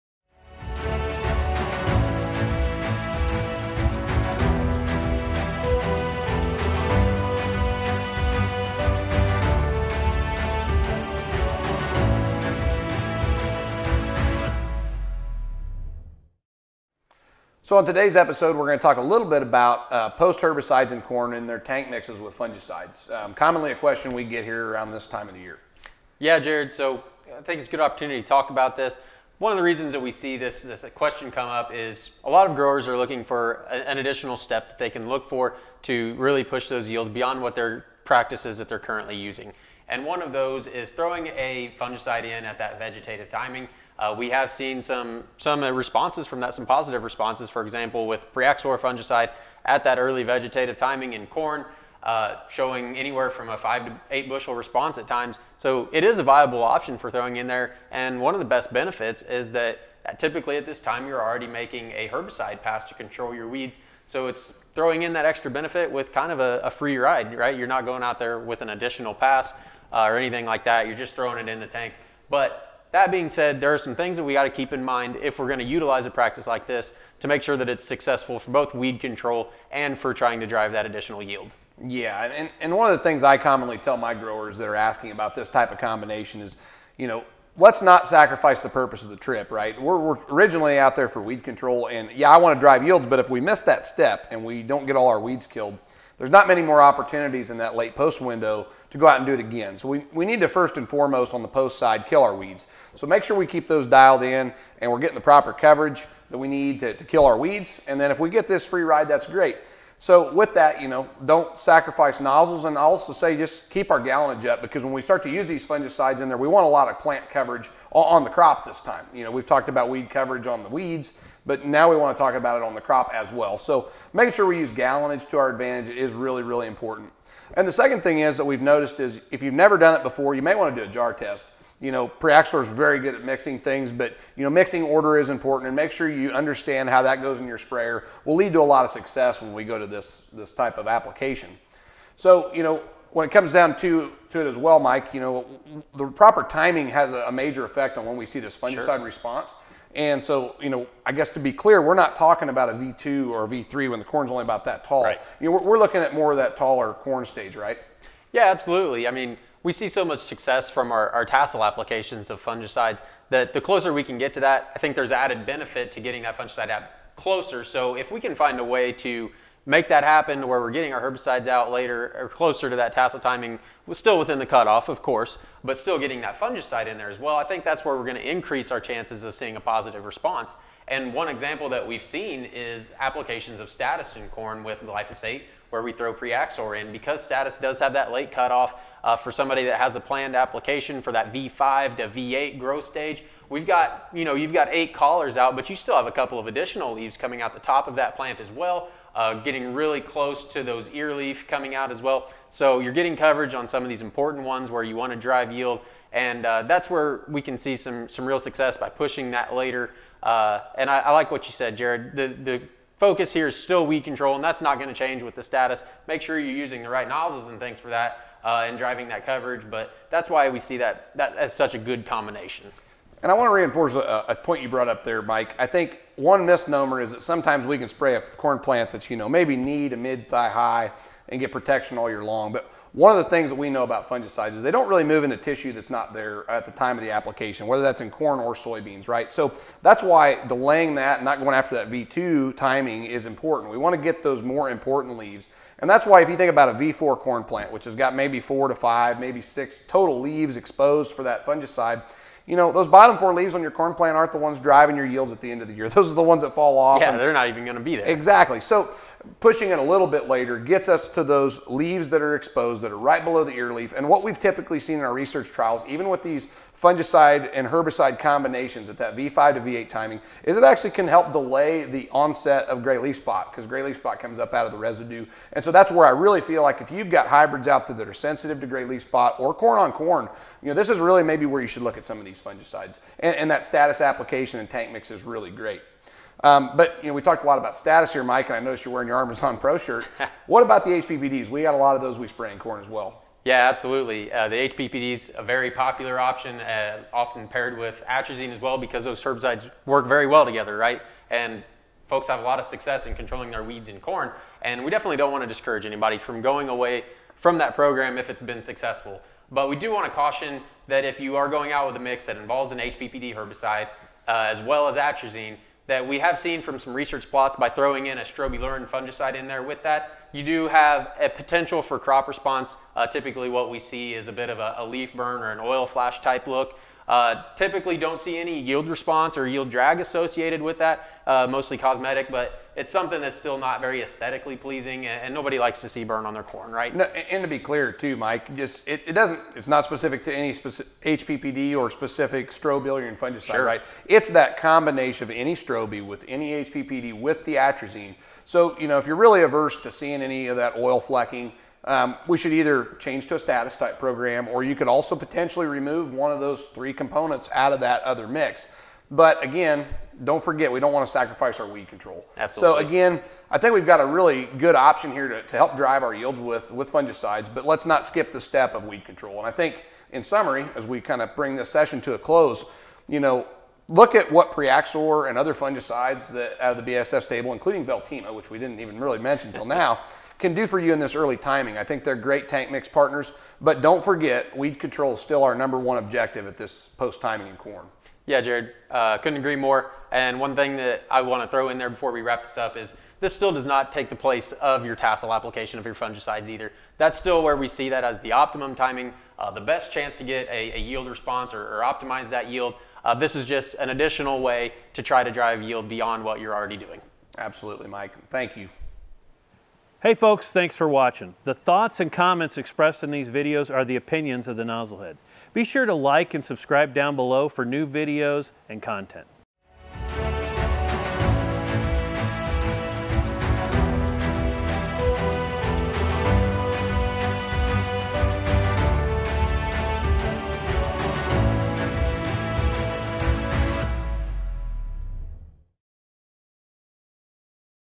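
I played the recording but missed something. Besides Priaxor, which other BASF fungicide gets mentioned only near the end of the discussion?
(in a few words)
Veltyma.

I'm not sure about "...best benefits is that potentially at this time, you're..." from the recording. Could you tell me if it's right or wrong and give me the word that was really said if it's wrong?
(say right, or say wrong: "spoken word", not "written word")
wrong: "typically", not "potentially".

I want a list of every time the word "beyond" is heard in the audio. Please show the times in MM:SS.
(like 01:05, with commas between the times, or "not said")
00:37, 06:45.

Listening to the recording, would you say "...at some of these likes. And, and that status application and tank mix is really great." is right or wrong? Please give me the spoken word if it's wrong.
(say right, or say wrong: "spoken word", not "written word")
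wrong: "fungicides", not "likes".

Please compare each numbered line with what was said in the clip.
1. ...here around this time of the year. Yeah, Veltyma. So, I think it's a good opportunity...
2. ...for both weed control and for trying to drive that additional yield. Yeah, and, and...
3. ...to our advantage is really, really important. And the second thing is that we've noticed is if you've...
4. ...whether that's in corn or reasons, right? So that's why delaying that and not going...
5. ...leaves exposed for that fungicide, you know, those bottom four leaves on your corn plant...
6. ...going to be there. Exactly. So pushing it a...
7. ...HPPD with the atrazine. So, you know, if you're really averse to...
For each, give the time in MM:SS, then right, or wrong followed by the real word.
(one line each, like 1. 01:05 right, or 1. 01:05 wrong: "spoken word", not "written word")
1. 00:24 wrong: "Jared", not "Veltyma"
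2. 01:18 right
3. 02:05 right
4. 03:57 wrong: "soybeans", not "reasons"
5. 04:10 right
6. 04:17 right
7. 05:46 right.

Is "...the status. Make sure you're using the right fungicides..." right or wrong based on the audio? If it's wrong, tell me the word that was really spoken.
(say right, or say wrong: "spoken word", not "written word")
wrong: "nozzles", not "fungicides".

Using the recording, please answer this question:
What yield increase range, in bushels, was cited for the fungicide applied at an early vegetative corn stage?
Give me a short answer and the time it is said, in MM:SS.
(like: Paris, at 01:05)
5 to 8 bushels, at 00:53.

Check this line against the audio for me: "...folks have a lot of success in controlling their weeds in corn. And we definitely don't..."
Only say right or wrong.
right.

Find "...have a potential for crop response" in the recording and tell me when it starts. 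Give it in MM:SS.
05:20.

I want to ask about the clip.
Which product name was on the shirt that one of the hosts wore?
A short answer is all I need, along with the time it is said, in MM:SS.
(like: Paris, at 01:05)
Armezon Pro, at 04:49.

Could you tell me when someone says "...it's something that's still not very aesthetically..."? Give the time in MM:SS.
05:32.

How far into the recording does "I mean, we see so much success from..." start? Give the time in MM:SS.
02:39.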